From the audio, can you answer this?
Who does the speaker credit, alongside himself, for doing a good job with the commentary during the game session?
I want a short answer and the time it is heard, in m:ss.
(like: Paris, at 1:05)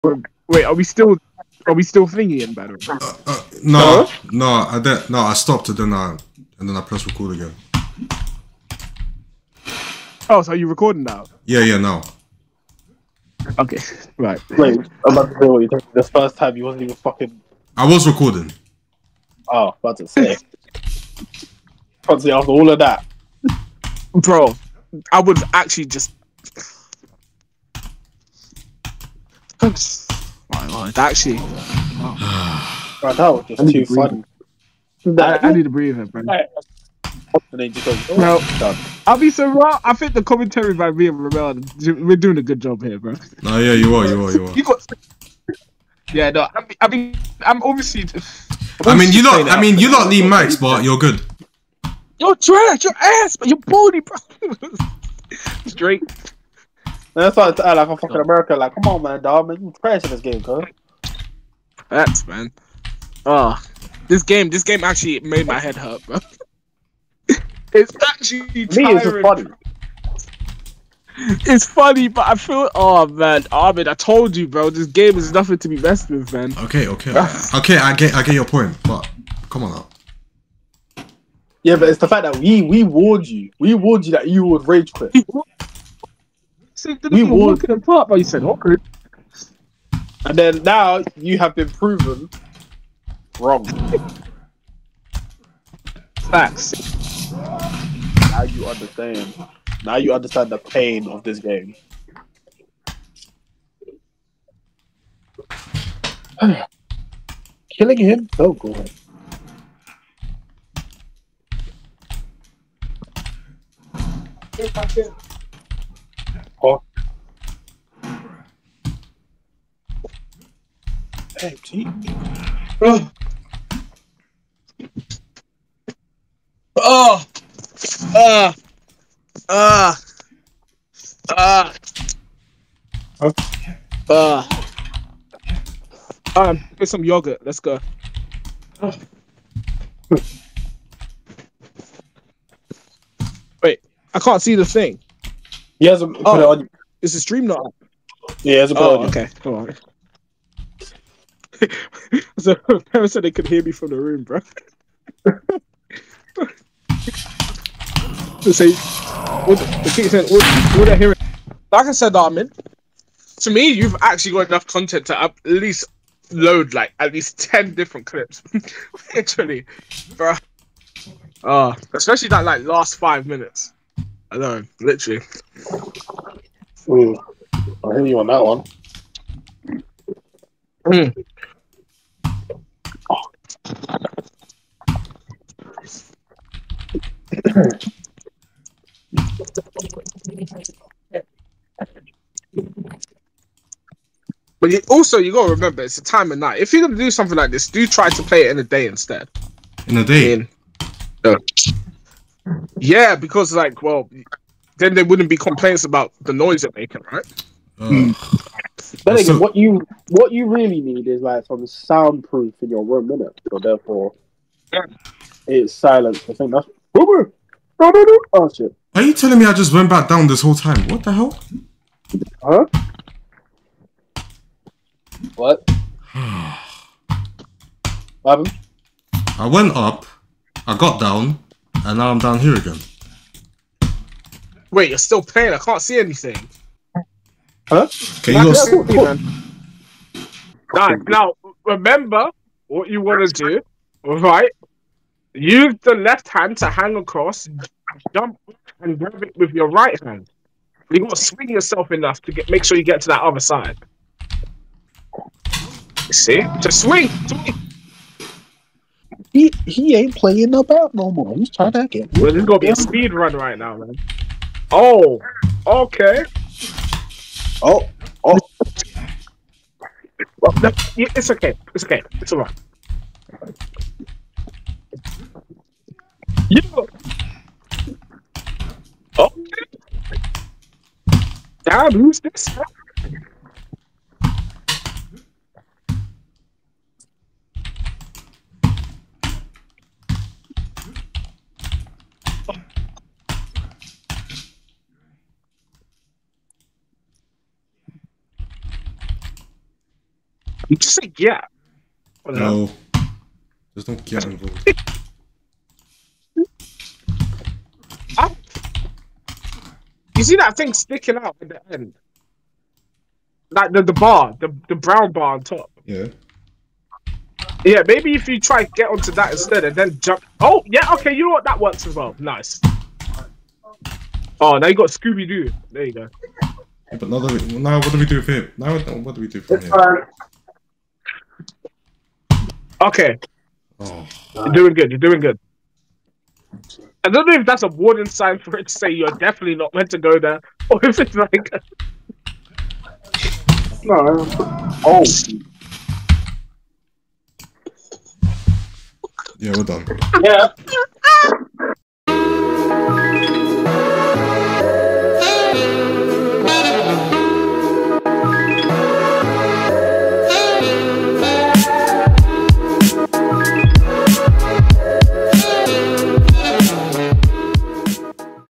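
Ramel, at 0:41.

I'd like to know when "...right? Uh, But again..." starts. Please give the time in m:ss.
3:27.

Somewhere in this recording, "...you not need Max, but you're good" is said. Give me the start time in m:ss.
0:49.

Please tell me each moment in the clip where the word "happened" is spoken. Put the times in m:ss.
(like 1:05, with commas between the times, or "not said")
3:48.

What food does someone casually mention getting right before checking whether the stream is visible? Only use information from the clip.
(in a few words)
yogurt.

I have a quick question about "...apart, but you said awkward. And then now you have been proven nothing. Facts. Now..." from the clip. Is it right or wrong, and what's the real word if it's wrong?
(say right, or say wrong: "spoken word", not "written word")
wrong: "wrong", not "nothing".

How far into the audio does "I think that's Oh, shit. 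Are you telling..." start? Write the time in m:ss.
3:36.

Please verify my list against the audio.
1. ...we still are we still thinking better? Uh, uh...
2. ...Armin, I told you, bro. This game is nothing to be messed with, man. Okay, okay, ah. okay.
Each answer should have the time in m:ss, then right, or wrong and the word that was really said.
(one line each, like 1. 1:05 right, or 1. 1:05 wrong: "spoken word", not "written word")
1. 0:00 right
2. 1:13 right.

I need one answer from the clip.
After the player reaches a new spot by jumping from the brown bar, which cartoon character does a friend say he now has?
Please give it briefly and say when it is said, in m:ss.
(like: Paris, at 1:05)
Scooby Doo, at 5:24.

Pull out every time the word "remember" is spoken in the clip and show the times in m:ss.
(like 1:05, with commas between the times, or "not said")
3:15, 4:01.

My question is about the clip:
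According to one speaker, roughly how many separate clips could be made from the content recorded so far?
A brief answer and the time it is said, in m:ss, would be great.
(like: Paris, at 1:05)
10, at 2:47.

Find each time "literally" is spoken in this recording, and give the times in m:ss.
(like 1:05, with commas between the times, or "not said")
2:49, 2:54.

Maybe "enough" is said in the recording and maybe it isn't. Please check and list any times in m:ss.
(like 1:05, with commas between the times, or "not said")
2:44, 4:11.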